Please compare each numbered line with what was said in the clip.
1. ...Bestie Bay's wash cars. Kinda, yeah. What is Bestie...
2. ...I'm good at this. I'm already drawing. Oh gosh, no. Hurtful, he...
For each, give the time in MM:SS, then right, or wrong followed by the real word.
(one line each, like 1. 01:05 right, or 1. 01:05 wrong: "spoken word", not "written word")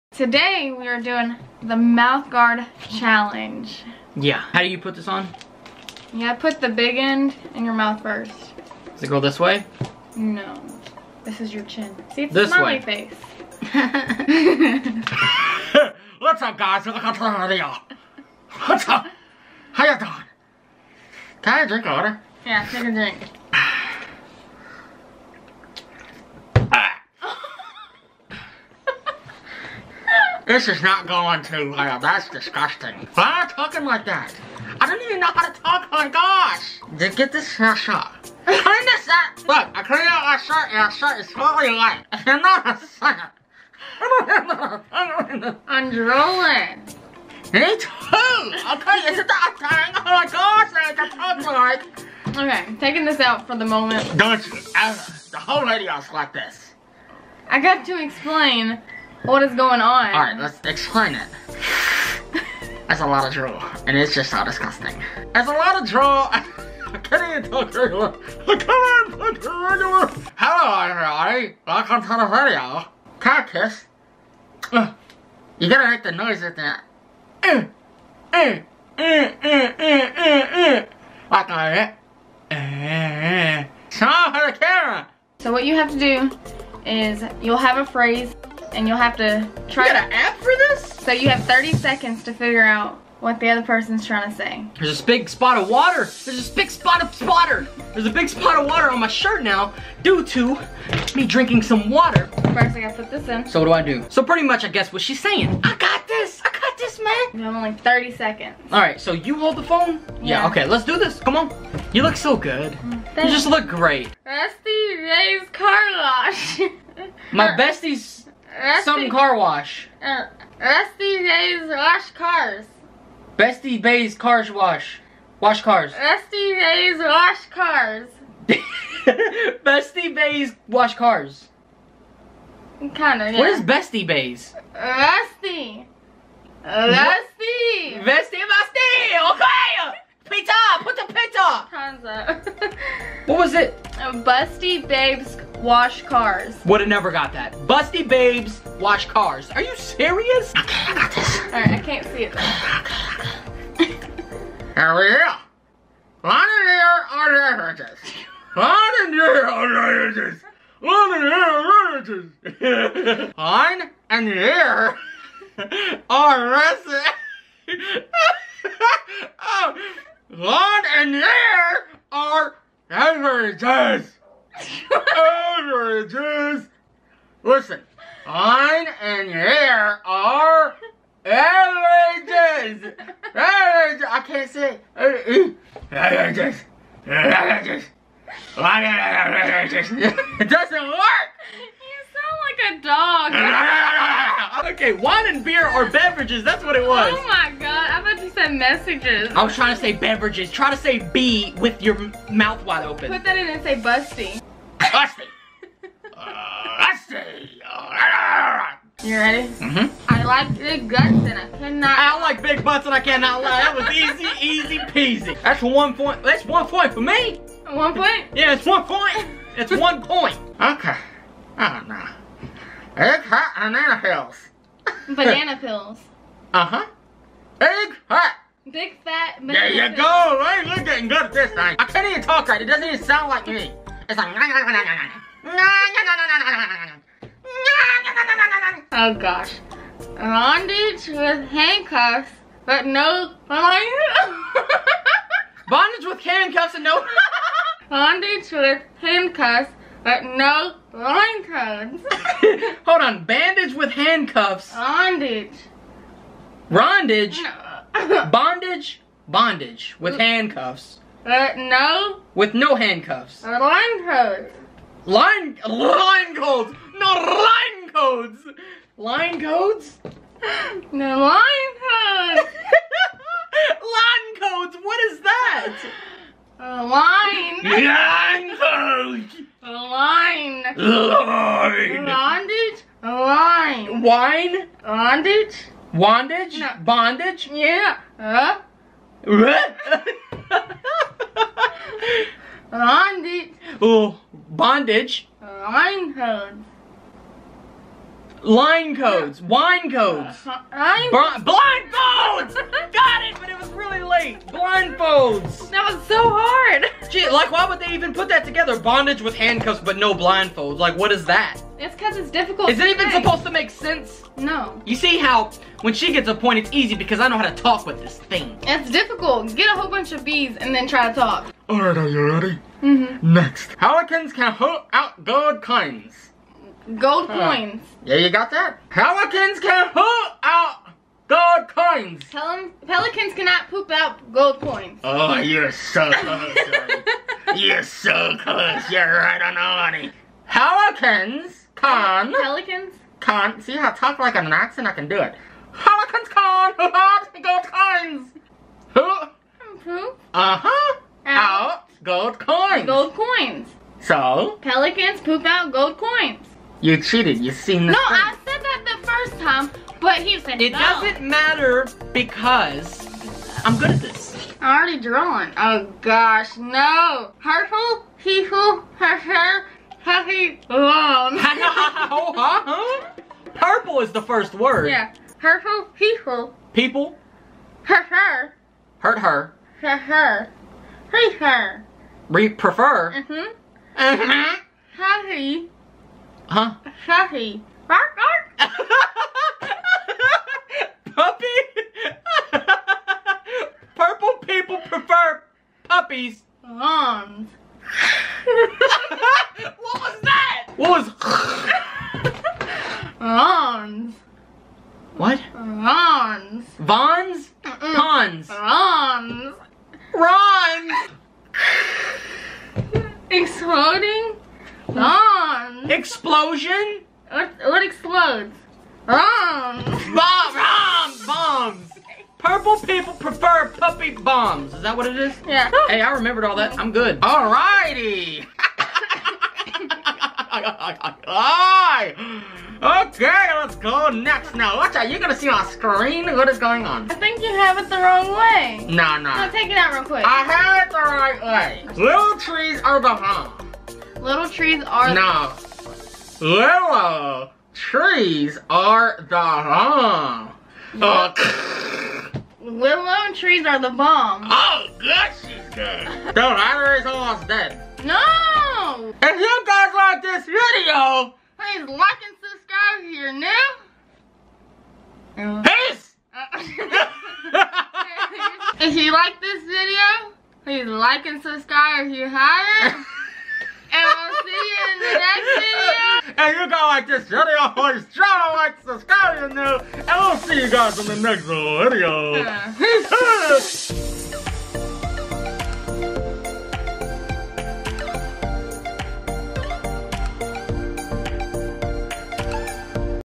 1. 02:08 right
2. 06:03 right.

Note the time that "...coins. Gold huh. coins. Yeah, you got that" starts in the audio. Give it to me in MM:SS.
05:25.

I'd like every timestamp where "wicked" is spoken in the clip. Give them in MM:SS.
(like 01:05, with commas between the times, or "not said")
not said.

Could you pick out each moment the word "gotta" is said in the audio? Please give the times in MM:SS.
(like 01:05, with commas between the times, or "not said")
01:15, 01:42.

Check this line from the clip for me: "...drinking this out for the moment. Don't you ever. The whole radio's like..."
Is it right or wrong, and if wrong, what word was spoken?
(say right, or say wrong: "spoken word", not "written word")
wrong: "taking", not "drinking".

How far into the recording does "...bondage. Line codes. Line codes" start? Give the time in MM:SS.
04:54.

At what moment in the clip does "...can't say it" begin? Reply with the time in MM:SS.
03:04.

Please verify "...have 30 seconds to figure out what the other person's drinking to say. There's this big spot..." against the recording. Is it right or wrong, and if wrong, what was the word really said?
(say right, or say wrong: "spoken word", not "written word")
wrong: "trying", not "drinking".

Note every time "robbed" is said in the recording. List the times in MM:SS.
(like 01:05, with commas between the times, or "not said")
not said.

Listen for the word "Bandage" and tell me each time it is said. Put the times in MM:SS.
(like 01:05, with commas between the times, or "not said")
04:13.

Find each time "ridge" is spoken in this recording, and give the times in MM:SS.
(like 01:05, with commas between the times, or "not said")
not said.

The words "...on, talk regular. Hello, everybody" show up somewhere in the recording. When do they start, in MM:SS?
01:08.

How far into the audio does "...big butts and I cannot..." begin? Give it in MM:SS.
03:32.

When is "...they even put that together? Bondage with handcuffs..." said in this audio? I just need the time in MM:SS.
05:07.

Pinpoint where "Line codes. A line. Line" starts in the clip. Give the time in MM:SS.
04:37.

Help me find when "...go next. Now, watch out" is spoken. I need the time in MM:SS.
07:13.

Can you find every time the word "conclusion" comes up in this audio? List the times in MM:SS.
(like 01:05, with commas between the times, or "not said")
not said.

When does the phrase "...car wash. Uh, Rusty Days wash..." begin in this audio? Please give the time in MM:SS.
01:59.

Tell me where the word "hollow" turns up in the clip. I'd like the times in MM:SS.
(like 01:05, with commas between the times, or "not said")
not said.